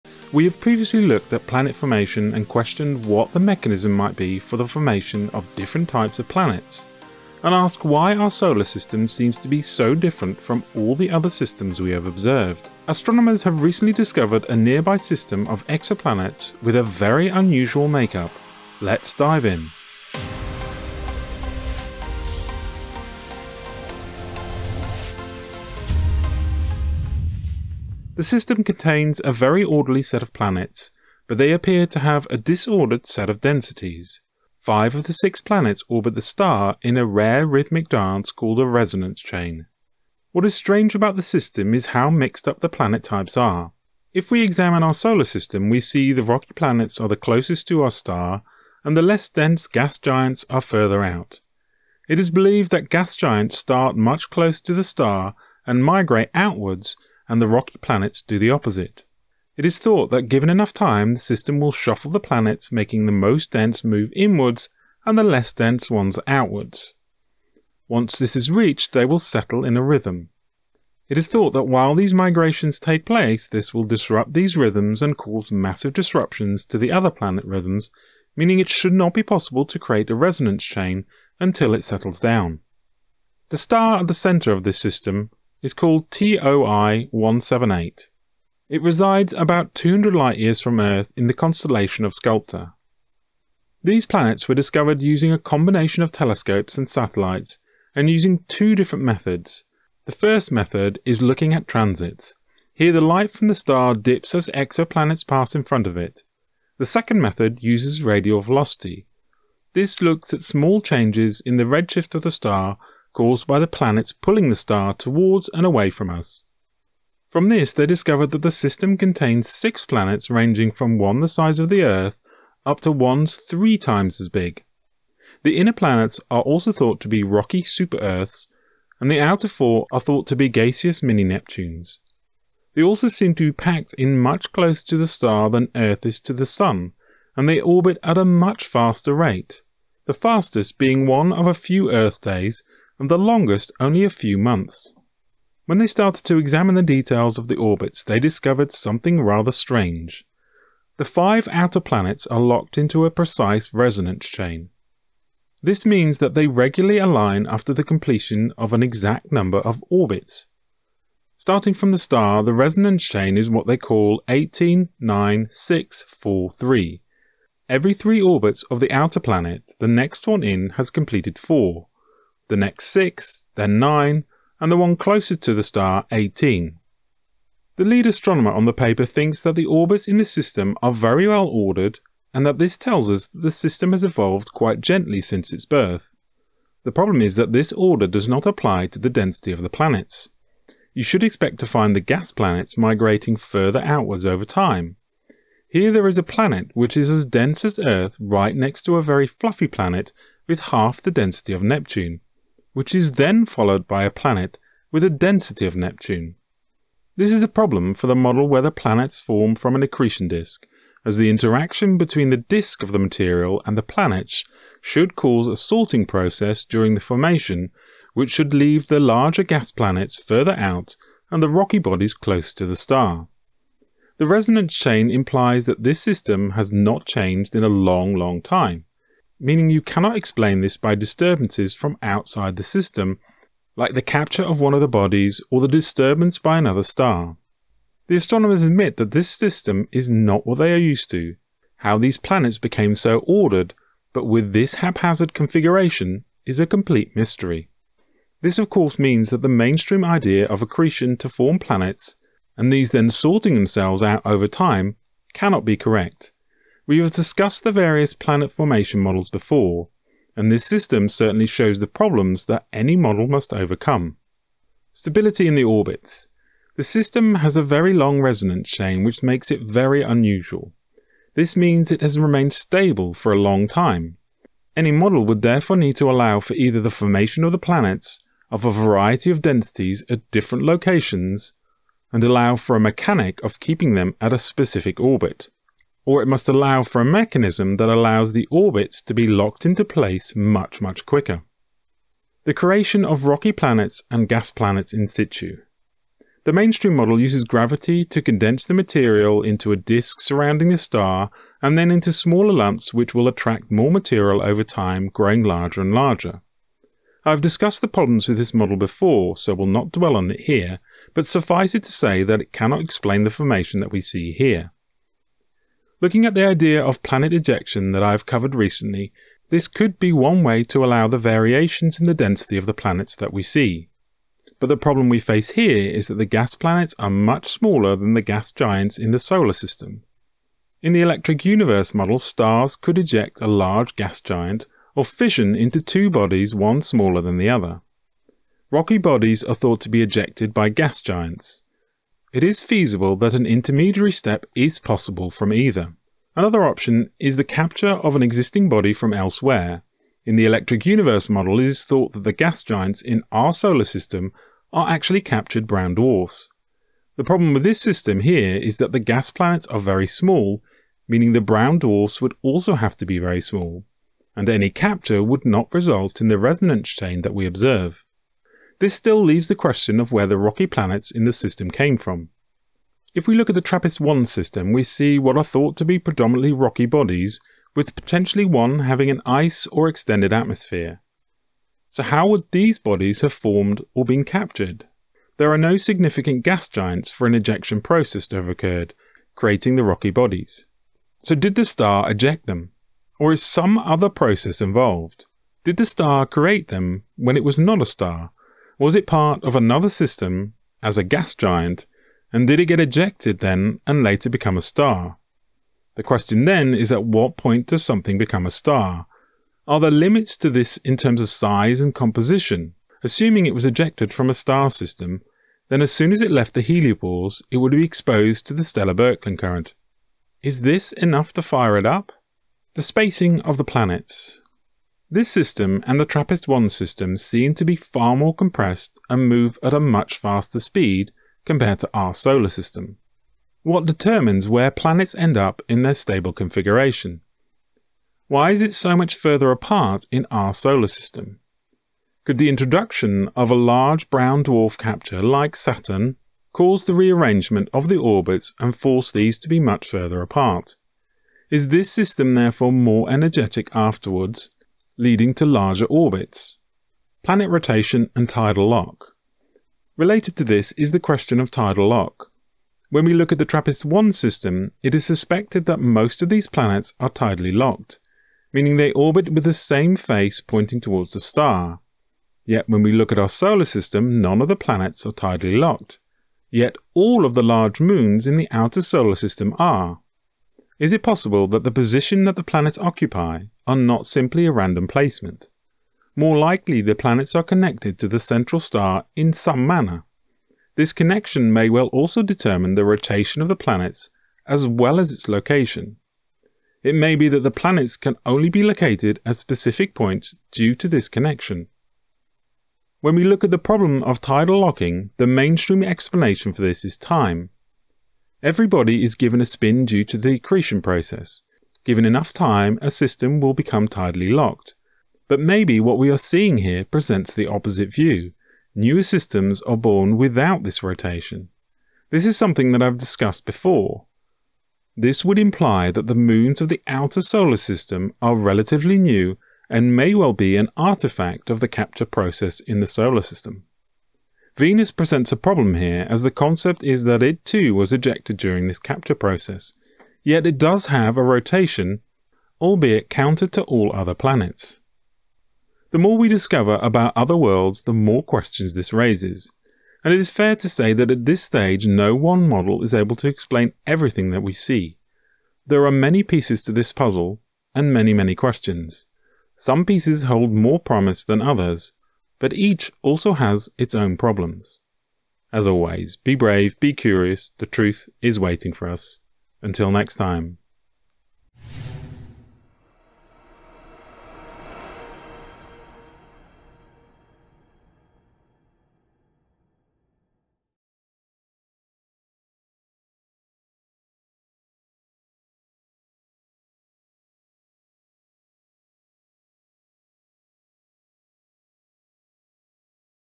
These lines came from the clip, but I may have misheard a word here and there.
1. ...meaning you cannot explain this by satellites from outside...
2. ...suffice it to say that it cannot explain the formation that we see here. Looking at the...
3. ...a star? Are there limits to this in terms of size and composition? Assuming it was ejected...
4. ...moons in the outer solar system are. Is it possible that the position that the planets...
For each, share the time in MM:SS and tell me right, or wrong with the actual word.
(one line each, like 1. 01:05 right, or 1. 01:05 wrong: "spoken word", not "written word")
1. 03:49 wrong: "disturbances", not "satellites"
2. 05:11 right
3. 06:48 right
4. 07:57 right.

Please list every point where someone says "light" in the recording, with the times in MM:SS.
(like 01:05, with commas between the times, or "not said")
01:30, 01:43.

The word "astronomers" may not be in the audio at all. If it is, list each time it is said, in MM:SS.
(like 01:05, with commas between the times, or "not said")
00:12, 02:58, 03:58.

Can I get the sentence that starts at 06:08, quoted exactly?
This still leaves the question of where the rocky planets in the system came from.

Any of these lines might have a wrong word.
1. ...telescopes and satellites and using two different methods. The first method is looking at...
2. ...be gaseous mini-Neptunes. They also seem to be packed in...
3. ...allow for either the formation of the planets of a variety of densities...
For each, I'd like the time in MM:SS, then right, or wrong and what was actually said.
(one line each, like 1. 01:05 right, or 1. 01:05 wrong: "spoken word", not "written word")
1. 01:36 right
2. 02:10 right
3. 04:36 right.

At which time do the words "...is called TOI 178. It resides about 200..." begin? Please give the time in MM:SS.
01:25.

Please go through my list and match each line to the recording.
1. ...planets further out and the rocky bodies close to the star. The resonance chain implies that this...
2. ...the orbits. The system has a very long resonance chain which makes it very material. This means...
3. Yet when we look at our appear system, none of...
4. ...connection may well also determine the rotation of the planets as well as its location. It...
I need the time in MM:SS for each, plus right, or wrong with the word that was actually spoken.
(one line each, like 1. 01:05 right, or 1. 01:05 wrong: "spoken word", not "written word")
1. 03:39 right
2. 04:25 wrong: "unusual", not "material"
3. 07:52 wrong: "solar", not "appear"
4. 08:10 right.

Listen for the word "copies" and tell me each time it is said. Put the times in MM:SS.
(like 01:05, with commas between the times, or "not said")
not said.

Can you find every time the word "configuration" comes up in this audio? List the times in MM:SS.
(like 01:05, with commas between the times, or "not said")
04:05, 07:16.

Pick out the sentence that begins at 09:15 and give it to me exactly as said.
There are many pieces to this puzzle, and many many questions.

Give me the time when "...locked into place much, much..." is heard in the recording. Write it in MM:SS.
04:49.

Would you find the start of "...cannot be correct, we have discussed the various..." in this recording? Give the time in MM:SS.
04:15.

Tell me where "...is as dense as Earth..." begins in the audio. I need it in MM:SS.
03:16.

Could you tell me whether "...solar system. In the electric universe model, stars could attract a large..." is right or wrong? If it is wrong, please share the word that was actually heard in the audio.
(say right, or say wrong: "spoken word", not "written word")
wrong: "eject", not "attract".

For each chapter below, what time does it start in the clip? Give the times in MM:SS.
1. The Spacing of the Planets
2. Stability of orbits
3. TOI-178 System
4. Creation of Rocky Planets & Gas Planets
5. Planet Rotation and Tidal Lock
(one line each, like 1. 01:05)
1. 07:03
2. 04:25
3. 00:27
4. 04:52
5. 07:37.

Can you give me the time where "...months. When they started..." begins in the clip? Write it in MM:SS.
02:24.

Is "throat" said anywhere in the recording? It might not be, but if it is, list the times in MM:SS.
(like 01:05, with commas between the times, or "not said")
not said.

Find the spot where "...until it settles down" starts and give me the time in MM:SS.
01:21.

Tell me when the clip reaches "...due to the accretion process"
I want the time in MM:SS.
08:29.